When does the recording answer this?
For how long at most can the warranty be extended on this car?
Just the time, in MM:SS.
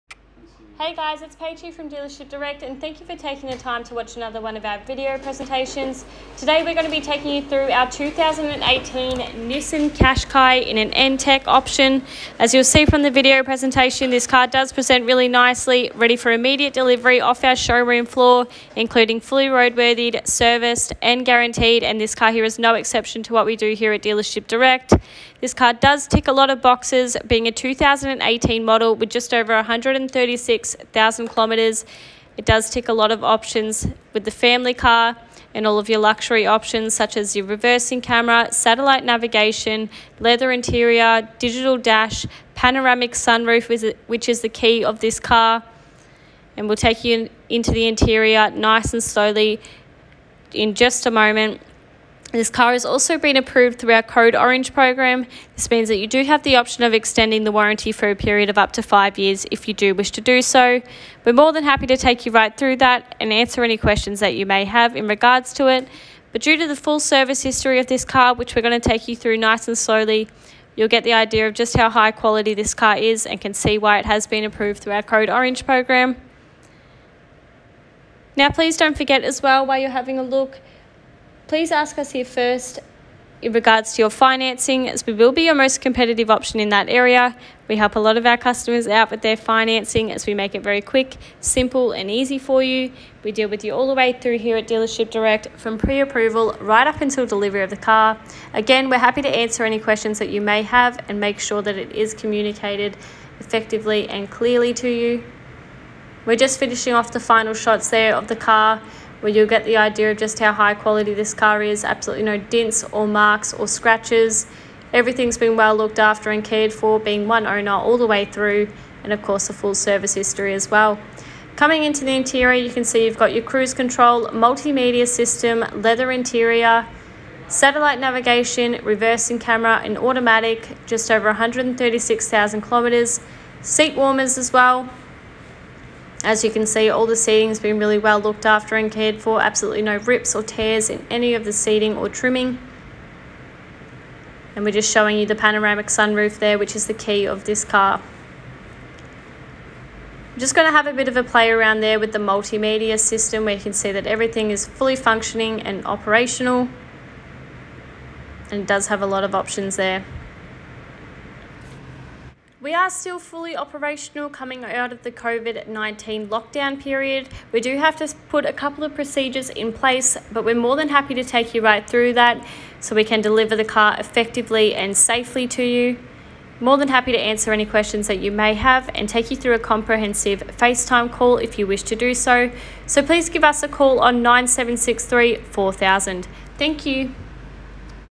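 00:58.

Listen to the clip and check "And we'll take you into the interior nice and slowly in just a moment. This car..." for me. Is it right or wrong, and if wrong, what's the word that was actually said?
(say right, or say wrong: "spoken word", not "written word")
right.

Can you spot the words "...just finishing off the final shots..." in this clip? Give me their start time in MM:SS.
01:46.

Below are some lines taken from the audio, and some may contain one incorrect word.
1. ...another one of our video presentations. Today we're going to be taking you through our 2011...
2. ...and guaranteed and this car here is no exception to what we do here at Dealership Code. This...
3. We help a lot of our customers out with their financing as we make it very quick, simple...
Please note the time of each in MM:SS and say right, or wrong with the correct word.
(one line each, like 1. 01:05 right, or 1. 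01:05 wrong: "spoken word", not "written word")
1. 00:04 wrong: "2018", not "2011"
2. 00:21 wrong: "Direct", not "Code"
3. 01:27 right.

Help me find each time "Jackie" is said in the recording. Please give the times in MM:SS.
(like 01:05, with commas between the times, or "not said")
not said.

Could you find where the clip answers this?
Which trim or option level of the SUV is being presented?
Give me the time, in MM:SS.
00:10.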